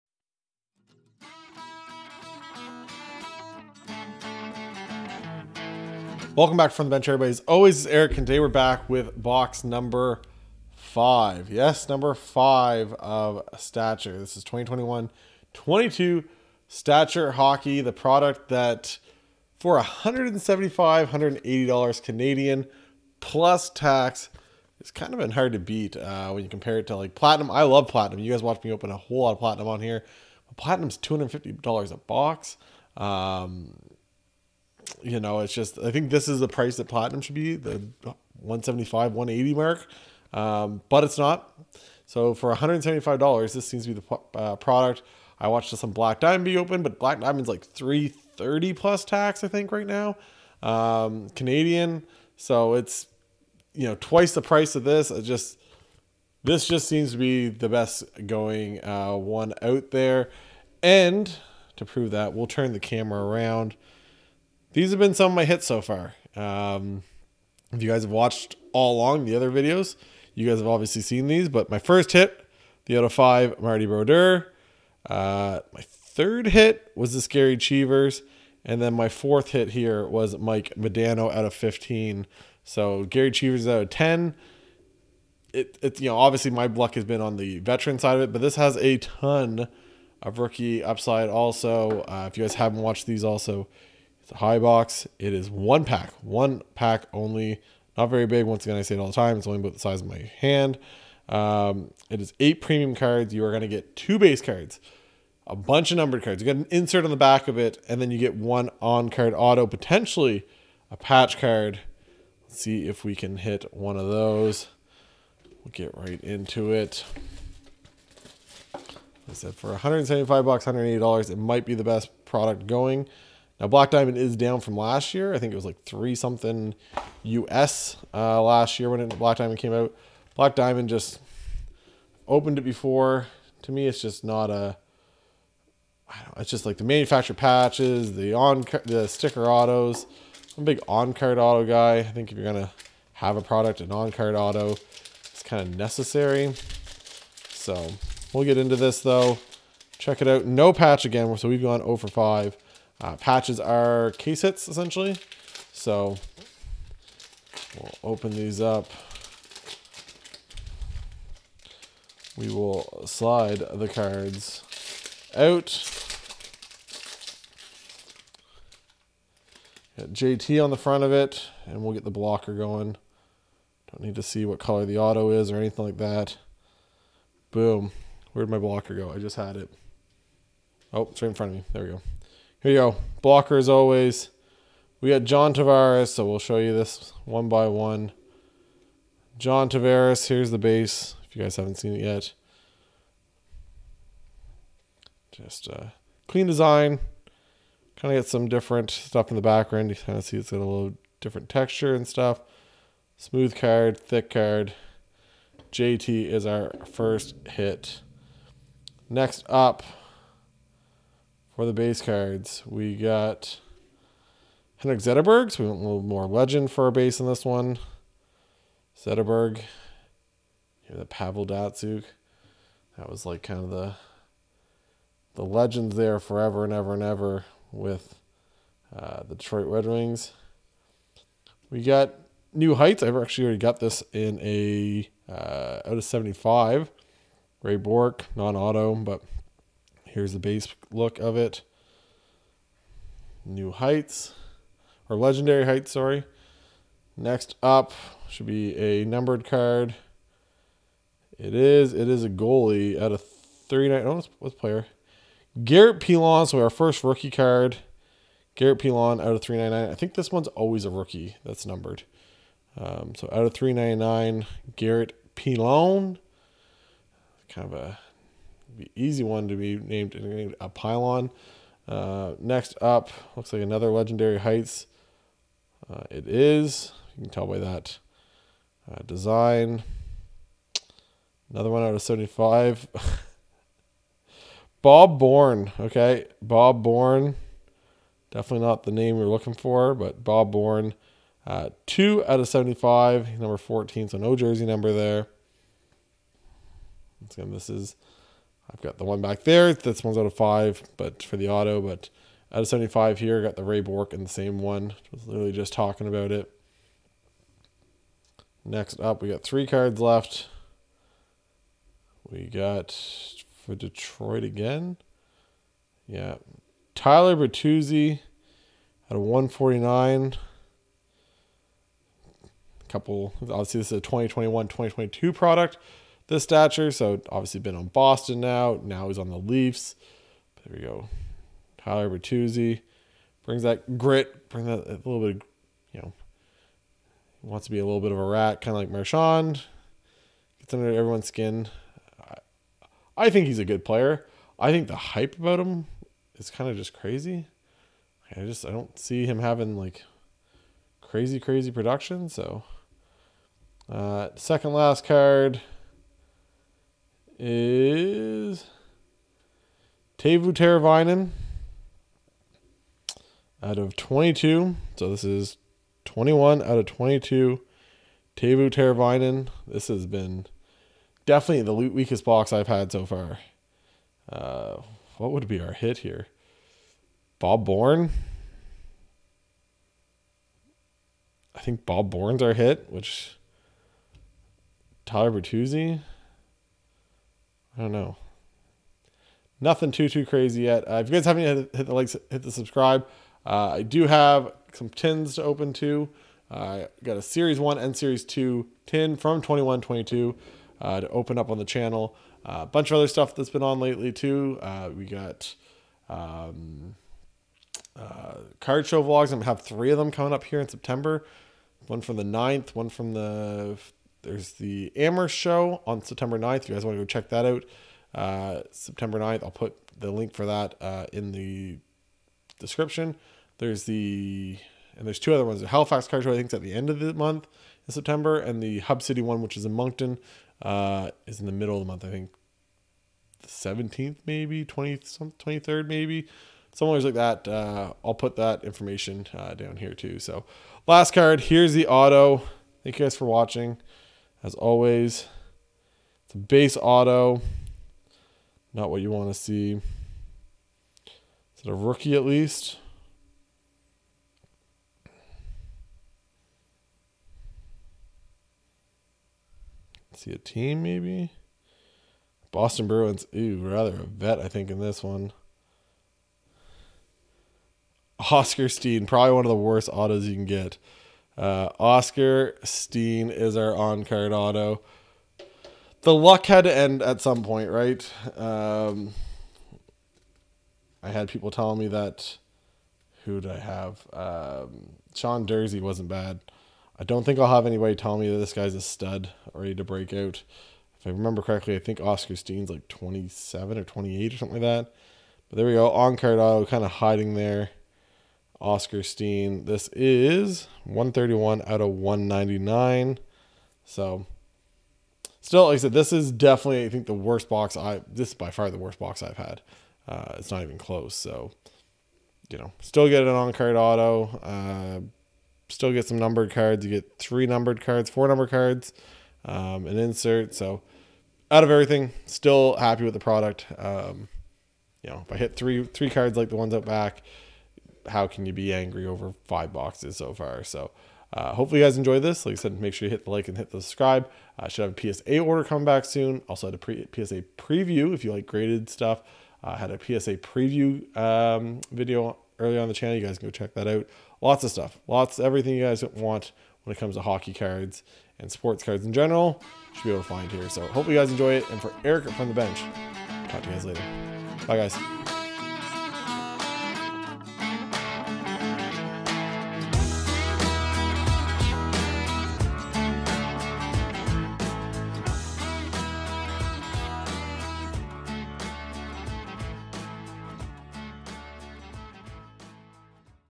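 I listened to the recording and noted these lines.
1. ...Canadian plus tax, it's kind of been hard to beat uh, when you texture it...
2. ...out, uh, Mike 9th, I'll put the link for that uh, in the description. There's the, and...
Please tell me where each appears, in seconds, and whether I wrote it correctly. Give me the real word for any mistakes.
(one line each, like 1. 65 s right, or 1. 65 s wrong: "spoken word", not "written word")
1. 22 s wrong: "compare", not "texture"
2. 417 s wrong: "September", not "Mike".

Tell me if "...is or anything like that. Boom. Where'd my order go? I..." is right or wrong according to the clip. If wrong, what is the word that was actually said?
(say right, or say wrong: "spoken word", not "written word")
wrong: "blocker", not "order".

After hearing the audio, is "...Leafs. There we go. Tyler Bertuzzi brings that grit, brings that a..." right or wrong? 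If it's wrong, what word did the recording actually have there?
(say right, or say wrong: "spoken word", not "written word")
right.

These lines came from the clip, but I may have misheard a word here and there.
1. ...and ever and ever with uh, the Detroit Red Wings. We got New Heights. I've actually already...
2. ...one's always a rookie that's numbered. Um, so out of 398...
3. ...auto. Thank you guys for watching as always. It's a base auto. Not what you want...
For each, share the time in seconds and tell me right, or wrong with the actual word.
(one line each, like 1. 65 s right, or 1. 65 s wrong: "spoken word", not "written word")
1. 226 s right
2. 260 s wrong: "399", not "398"
3. 441 s right.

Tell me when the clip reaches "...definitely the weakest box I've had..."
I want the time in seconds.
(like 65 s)
371 s.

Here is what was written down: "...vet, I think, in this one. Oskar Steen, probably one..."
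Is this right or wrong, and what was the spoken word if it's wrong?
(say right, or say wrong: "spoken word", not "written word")
right.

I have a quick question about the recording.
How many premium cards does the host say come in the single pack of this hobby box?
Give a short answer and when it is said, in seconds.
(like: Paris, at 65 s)
8, at 102 s.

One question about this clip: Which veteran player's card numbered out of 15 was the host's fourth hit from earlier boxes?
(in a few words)
Mike Modano.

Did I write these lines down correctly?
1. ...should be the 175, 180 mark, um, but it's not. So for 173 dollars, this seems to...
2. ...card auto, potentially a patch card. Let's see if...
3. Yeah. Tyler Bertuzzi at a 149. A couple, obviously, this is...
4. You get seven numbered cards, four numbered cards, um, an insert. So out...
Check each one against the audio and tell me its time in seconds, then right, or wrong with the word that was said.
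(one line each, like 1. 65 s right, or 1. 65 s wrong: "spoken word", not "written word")
1. 37 s wrong: "175", not "173"
2. 109 s right
3. 316 s right
4. 516 s wrong: "three", not "seven".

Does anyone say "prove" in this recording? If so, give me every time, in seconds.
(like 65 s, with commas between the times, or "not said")
61 s.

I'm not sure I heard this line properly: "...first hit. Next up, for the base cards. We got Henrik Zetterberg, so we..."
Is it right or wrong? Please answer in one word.
right.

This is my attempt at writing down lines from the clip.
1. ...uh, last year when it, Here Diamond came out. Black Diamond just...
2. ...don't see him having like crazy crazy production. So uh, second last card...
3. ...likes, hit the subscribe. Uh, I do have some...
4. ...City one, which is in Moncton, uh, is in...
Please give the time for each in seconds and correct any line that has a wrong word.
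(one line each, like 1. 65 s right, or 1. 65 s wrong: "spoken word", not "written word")
1. 128 s wrong: "Black", not "Here"
2. 348 s right
3. 391 s right
4. 429 s right.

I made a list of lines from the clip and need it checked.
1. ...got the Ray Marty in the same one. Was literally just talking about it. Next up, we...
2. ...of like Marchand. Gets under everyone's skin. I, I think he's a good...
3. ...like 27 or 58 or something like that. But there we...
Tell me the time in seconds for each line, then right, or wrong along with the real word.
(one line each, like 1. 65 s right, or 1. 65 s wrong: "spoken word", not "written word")
1. 303 s wrong: "Bourque", not "Marty"
2. 338 s right
3. 492 s wrong: "28", not "58".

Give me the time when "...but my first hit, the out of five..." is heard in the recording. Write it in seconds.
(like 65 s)
71 s.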